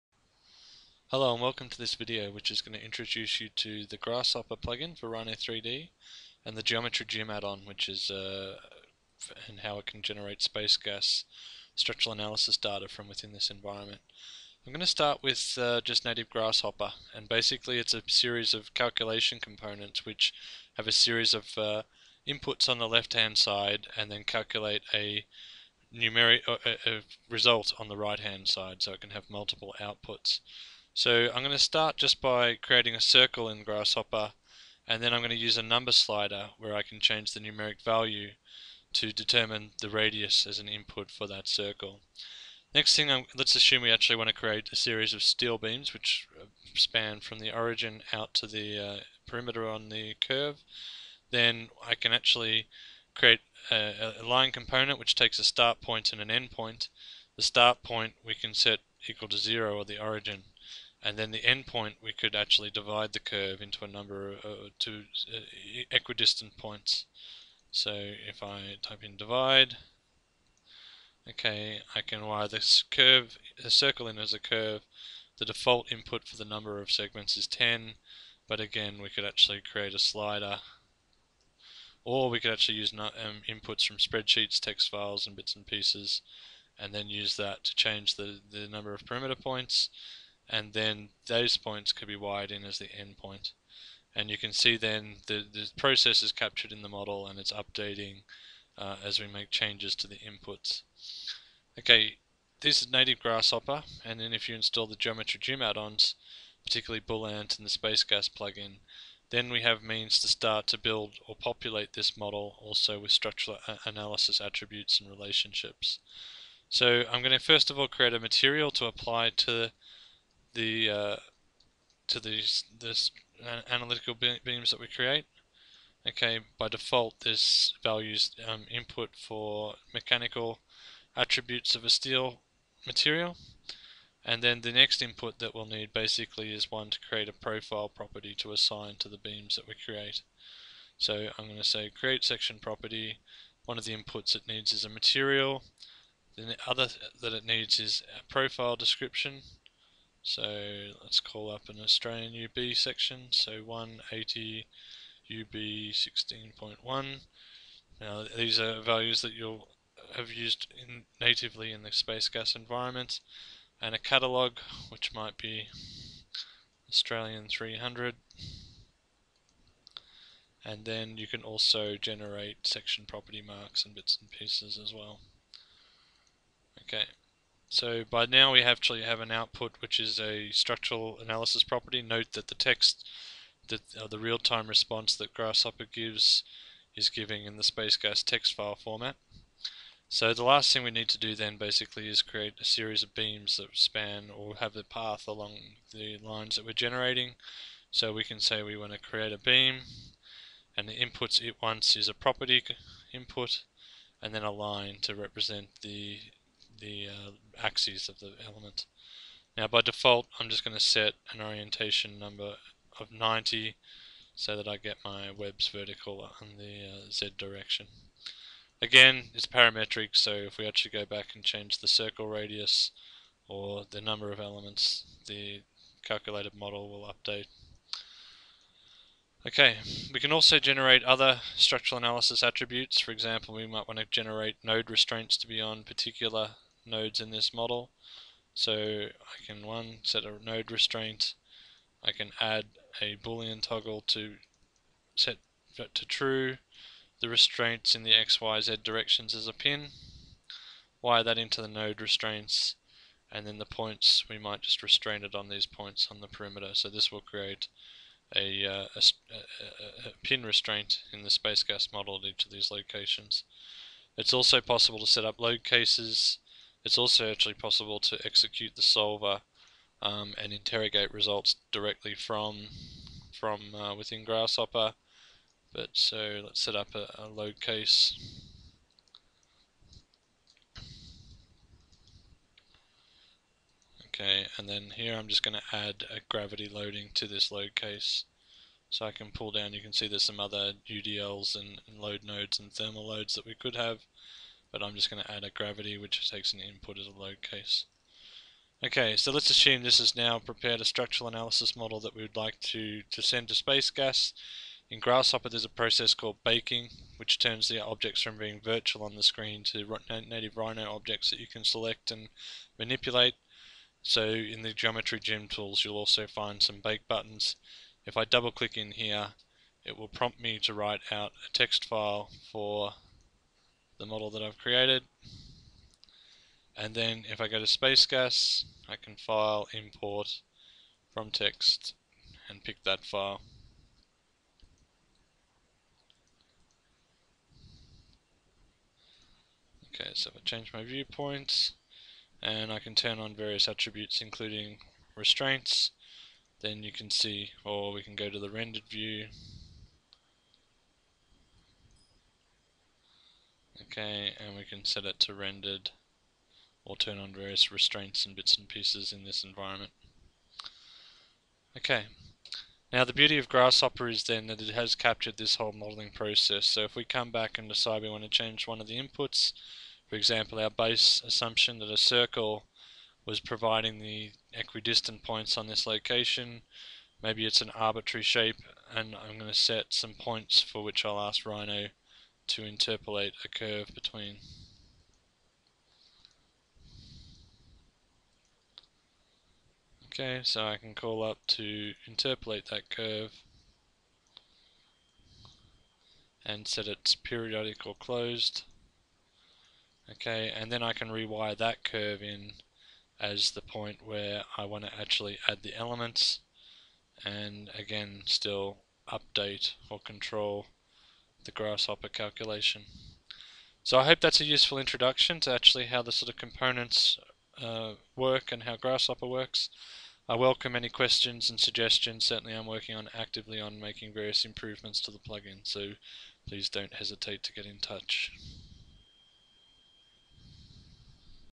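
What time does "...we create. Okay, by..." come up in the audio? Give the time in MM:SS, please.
02:04.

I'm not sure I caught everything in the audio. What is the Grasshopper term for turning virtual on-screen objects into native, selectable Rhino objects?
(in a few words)
baking.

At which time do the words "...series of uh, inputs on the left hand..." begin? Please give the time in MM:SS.
00:20.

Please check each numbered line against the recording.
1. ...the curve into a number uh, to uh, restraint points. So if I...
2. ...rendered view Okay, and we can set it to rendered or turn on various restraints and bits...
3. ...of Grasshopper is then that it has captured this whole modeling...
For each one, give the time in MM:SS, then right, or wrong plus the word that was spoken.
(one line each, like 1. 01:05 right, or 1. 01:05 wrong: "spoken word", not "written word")
1. 01:03 wrong: "equidistant", not "restraint"
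2. 05:48 right
3. 06:03 right.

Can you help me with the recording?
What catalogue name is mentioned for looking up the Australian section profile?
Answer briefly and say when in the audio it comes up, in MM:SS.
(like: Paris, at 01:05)
Australian 300, at 02:46.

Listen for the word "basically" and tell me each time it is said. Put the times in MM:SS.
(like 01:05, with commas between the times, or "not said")
00:17, 02:15, 03:11.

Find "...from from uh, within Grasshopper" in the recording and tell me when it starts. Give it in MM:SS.
04:32.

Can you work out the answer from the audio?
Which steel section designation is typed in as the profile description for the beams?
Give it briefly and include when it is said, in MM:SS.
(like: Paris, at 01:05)
180 UB 16.1, at 02:33.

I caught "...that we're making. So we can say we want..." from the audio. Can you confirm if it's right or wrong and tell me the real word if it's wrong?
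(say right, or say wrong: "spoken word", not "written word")
wrong: "generating", not "making".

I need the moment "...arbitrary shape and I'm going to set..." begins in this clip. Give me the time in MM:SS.
06:17.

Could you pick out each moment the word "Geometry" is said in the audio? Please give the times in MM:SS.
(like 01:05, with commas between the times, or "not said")
00:06, 01:44, 05:14.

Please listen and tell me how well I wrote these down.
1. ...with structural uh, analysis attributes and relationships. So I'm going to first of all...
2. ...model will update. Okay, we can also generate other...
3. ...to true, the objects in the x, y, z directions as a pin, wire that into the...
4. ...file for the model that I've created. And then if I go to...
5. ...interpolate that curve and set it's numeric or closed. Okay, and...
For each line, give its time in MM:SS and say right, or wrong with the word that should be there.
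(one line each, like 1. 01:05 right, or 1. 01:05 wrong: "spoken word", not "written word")
1. 01:52 right
2. 03:46 right
3. 04:05 wrong: "restraints", not "objects"
4. 05:21 right
5. 06:32 wrong: "periodic", not "numeric".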